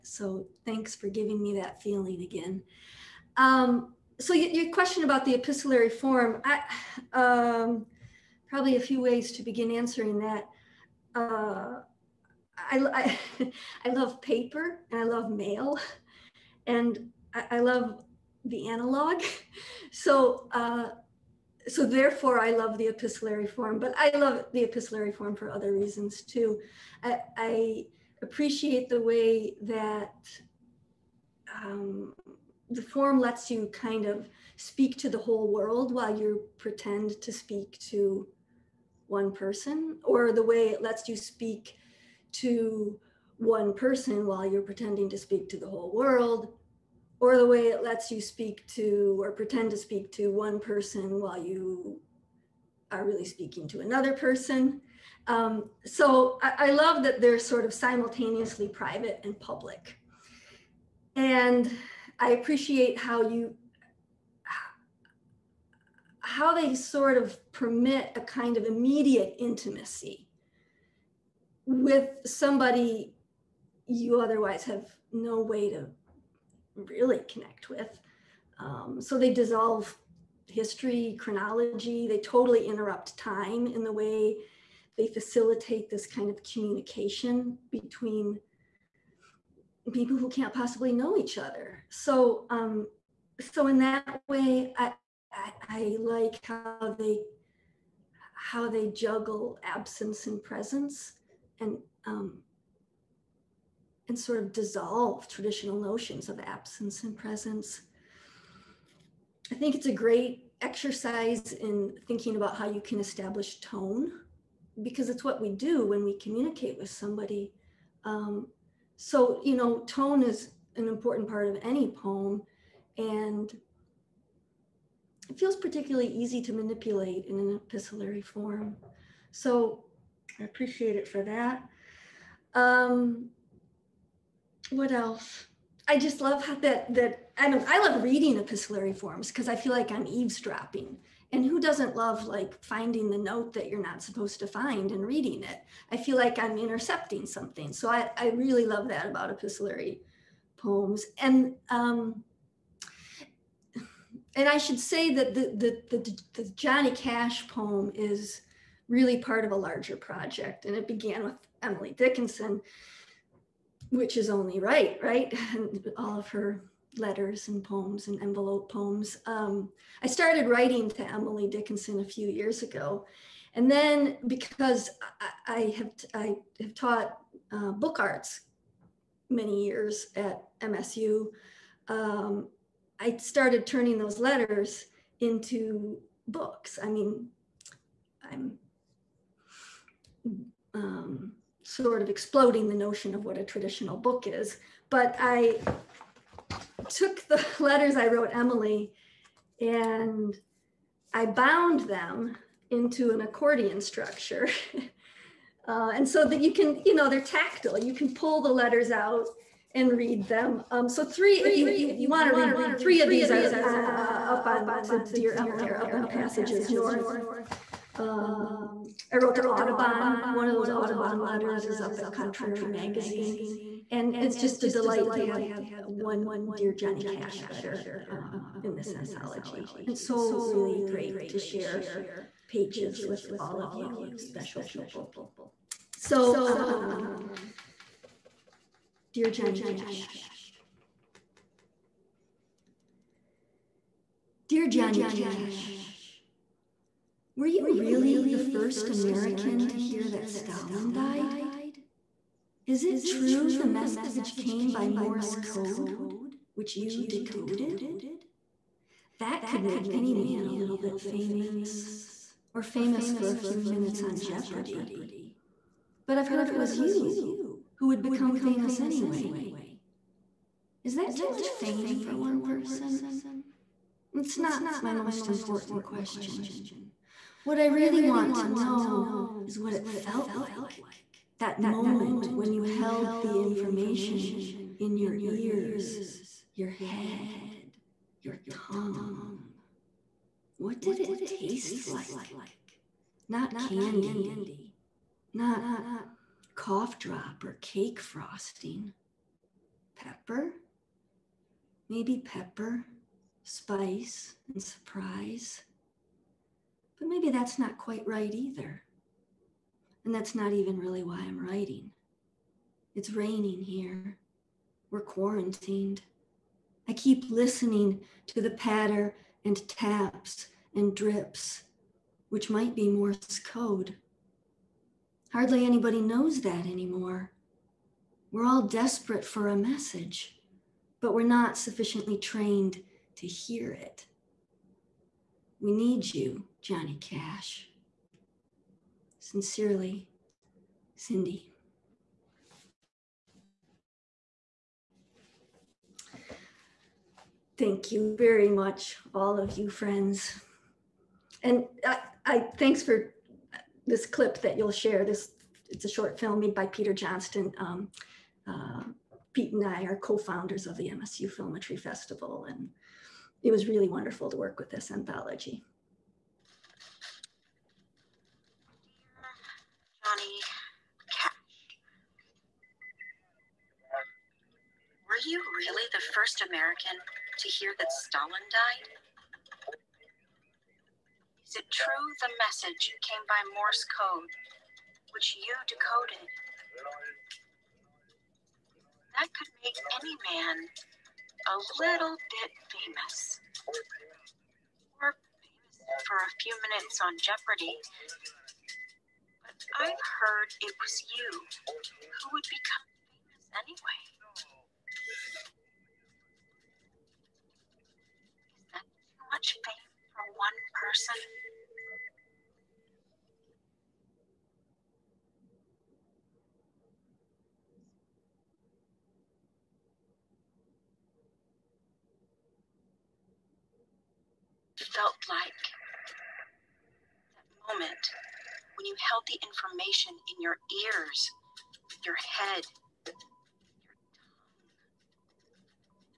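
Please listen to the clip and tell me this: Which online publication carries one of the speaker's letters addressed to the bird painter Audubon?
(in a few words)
Contrary Magazine.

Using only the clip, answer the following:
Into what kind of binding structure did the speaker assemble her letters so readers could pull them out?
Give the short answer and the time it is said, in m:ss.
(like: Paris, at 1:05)
accordion structure, at 3:23.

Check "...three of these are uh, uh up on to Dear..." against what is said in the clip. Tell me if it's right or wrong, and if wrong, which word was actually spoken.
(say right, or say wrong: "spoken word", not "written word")
right.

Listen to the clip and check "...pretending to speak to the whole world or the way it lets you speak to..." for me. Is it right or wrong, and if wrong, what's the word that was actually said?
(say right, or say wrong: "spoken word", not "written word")
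right.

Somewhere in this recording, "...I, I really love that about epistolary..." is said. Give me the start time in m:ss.
2:27.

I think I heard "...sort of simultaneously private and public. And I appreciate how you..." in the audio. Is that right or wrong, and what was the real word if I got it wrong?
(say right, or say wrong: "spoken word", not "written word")
right.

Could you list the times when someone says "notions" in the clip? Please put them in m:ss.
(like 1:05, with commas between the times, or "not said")
1:45, 3:12.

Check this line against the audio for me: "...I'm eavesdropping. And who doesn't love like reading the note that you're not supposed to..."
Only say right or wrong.
wrong.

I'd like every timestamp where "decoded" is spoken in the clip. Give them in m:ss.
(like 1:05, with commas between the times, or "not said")
4:17, 6:25.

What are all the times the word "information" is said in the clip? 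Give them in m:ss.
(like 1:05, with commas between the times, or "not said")
4:43, 7:09.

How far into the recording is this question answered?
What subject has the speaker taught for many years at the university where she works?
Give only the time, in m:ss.
2:57.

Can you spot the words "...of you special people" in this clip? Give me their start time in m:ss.
3:53.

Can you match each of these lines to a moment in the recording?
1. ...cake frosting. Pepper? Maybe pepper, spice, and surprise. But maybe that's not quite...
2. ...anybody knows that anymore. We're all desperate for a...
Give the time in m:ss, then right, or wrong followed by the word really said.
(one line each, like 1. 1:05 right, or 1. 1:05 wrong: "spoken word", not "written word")
1. 4:57 right
2. 5:25 right.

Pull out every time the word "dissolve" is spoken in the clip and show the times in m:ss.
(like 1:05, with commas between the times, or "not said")
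1:19, 1:44.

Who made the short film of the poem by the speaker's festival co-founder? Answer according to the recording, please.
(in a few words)
Peter Johnston.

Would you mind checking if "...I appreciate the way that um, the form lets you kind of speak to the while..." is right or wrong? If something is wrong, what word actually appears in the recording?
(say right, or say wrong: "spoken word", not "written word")
wrong: "whole", not "while".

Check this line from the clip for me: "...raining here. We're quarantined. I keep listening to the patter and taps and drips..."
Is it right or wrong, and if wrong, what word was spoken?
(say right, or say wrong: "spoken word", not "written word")
right.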